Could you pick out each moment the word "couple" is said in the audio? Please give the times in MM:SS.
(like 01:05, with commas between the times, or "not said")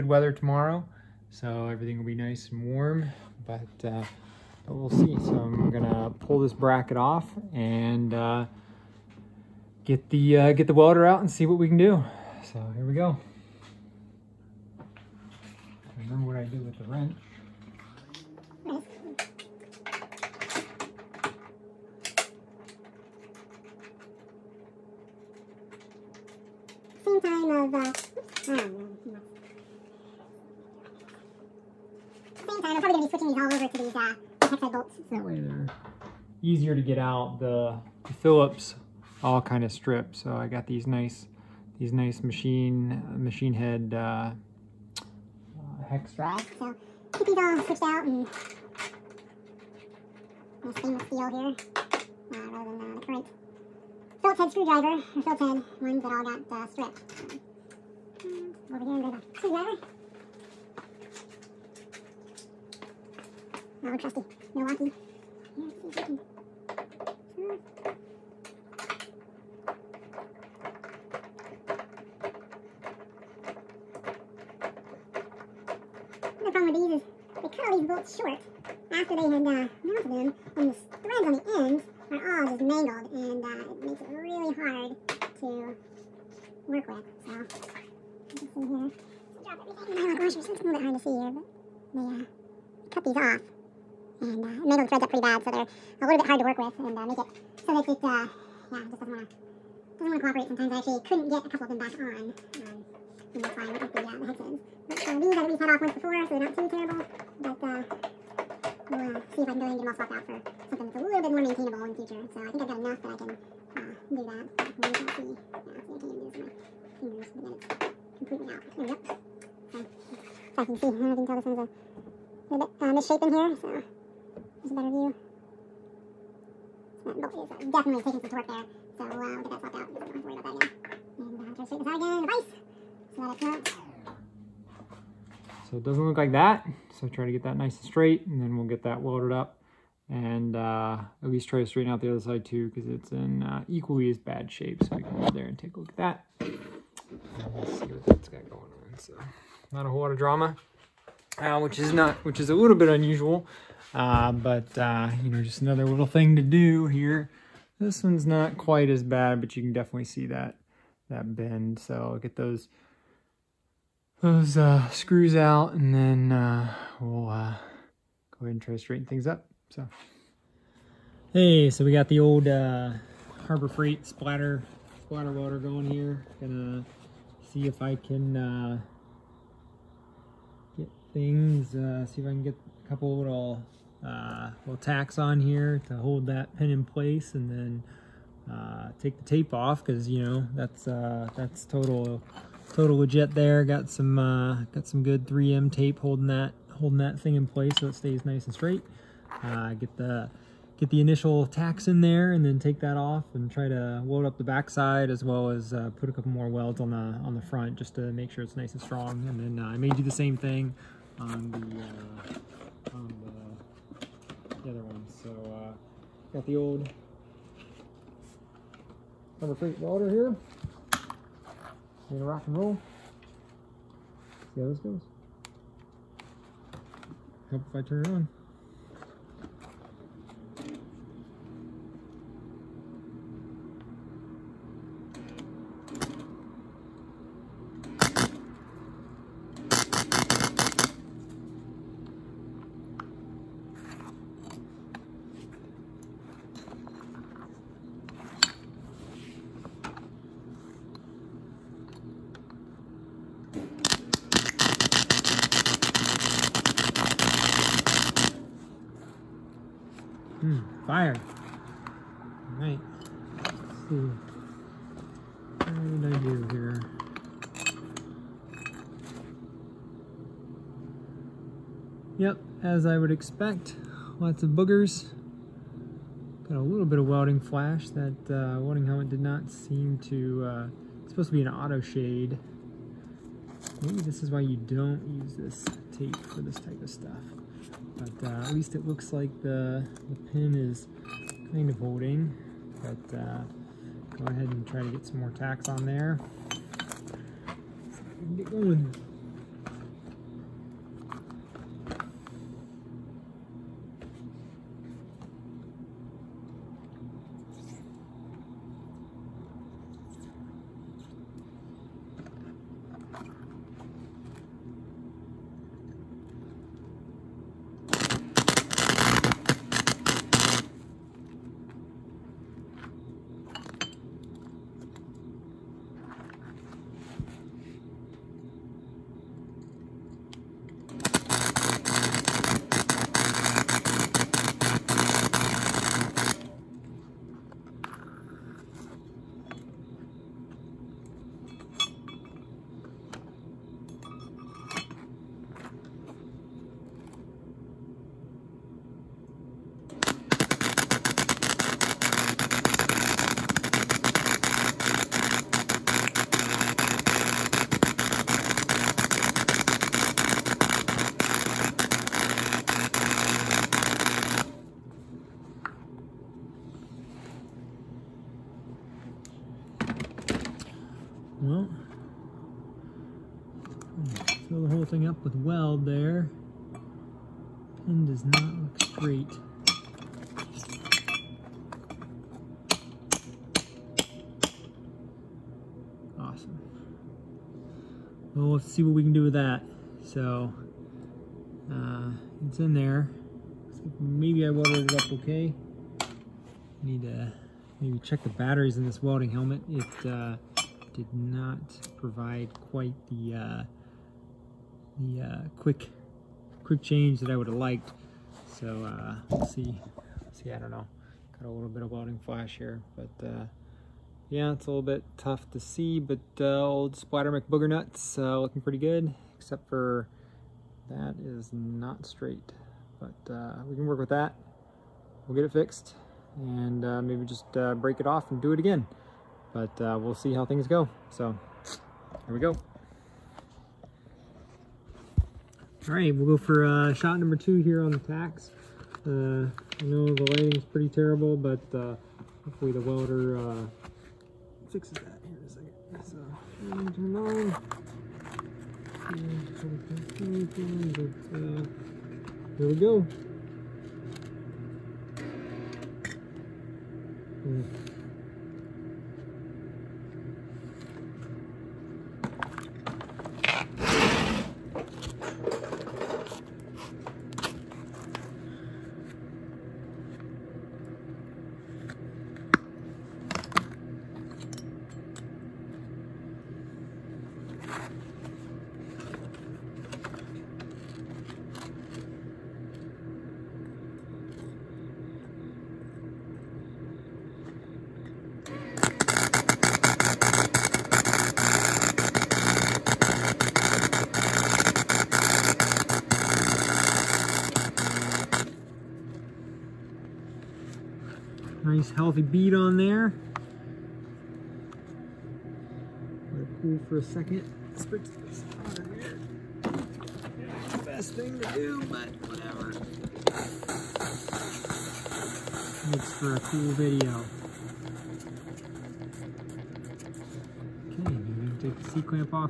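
01:41, 03:02, 03:26.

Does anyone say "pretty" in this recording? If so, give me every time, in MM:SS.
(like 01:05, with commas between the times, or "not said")
01:35, 06:58, 07:20.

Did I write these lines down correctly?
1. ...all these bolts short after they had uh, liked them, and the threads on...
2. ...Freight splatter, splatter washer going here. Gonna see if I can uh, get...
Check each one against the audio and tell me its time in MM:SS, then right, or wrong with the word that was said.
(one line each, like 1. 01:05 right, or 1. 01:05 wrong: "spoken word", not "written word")
1. 01:17 wrong: "mounted", not "liked"
2. 02:53 wrong: "water", not "washer".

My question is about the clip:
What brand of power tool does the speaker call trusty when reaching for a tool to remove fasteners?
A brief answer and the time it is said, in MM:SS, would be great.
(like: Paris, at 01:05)
Milwaukee, at 01:04.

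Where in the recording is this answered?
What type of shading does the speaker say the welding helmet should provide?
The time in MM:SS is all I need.
04:41.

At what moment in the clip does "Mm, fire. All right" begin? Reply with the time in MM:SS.
04:20.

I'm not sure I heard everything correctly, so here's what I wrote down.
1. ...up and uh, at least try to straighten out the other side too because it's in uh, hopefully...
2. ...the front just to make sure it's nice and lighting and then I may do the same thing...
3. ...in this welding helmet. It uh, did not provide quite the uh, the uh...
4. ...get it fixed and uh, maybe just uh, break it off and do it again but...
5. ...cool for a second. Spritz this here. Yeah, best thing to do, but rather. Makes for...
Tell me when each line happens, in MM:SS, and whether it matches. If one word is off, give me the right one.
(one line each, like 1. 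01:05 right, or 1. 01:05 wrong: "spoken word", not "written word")
1. 02:19 wrong: "equally", not "hopefully"
2. 03:27 wrong: "strong", not "lighting"
3. 06:38 right
4. 07:05 right
5. 08:26 wrong: "whatever", not "rather".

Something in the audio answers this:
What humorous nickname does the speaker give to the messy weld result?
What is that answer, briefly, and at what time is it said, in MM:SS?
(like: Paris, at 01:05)
Splatter McBooger Nuts, at 06:56.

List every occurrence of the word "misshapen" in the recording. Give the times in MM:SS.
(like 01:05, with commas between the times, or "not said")
02:02.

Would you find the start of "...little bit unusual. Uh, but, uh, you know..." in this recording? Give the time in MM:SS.
02:32.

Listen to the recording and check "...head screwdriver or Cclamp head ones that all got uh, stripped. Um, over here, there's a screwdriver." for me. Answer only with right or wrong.
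wrong.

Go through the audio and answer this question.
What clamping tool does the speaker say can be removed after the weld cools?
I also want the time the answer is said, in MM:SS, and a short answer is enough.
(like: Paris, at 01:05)
C-clamp, at 08:41.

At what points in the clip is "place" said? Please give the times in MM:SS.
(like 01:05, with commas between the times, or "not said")
03:06, 03:17.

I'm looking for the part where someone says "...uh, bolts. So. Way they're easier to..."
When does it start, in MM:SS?
00:34.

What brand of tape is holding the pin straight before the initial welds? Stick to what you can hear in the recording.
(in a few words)
3M.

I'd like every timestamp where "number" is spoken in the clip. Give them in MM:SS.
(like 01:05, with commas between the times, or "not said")
03:39, 07:17.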